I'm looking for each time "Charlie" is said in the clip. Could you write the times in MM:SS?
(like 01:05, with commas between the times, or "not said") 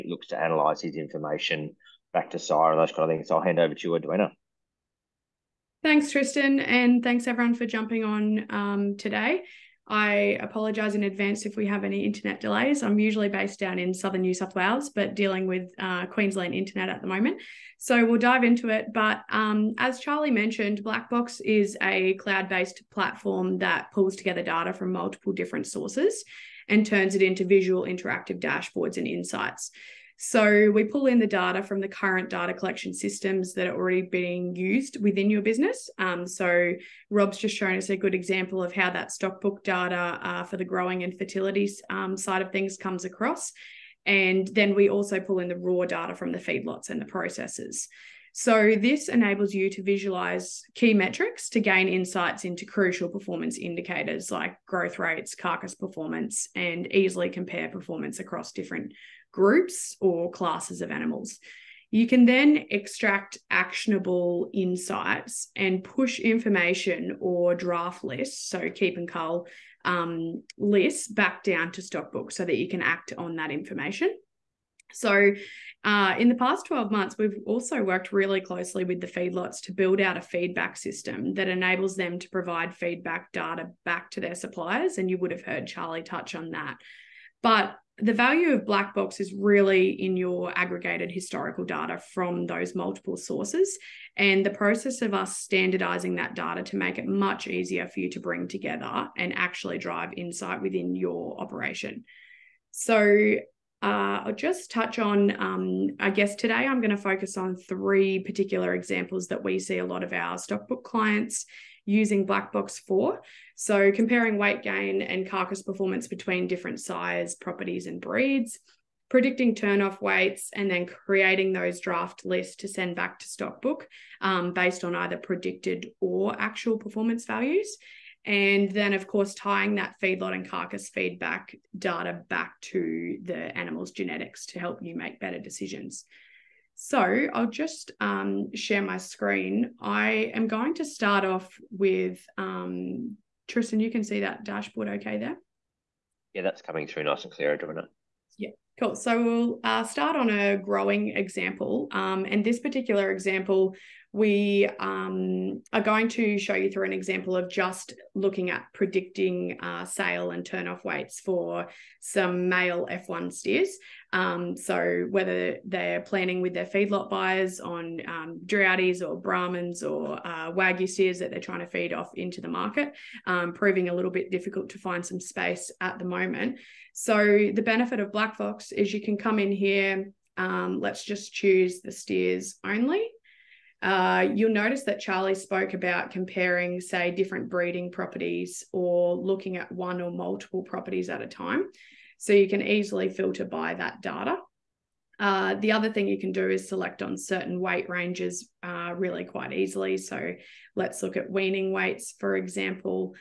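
00:19, 01:25, 03:05.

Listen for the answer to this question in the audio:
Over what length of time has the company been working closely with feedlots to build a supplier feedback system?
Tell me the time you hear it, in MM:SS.
01:16.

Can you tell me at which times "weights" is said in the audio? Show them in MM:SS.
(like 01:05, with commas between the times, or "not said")
01:54, 02:00, 02:40, 03:17, 03:21.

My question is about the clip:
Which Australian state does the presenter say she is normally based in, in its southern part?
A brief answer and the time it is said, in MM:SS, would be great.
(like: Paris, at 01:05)
New South Wales, at 00:14.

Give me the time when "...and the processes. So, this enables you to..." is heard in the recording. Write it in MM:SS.
00:46.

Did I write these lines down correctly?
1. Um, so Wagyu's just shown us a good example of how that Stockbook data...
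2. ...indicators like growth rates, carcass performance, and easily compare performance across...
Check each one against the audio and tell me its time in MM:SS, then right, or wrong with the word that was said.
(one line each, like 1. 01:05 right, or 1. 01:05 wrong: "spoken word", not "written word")
1. 00:35 wrong: "Rob", not "Wagyu"
2. 00:53 right.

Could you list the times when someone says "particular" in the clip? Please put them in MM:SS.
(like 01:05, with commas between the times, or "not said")
01:48, 02:32.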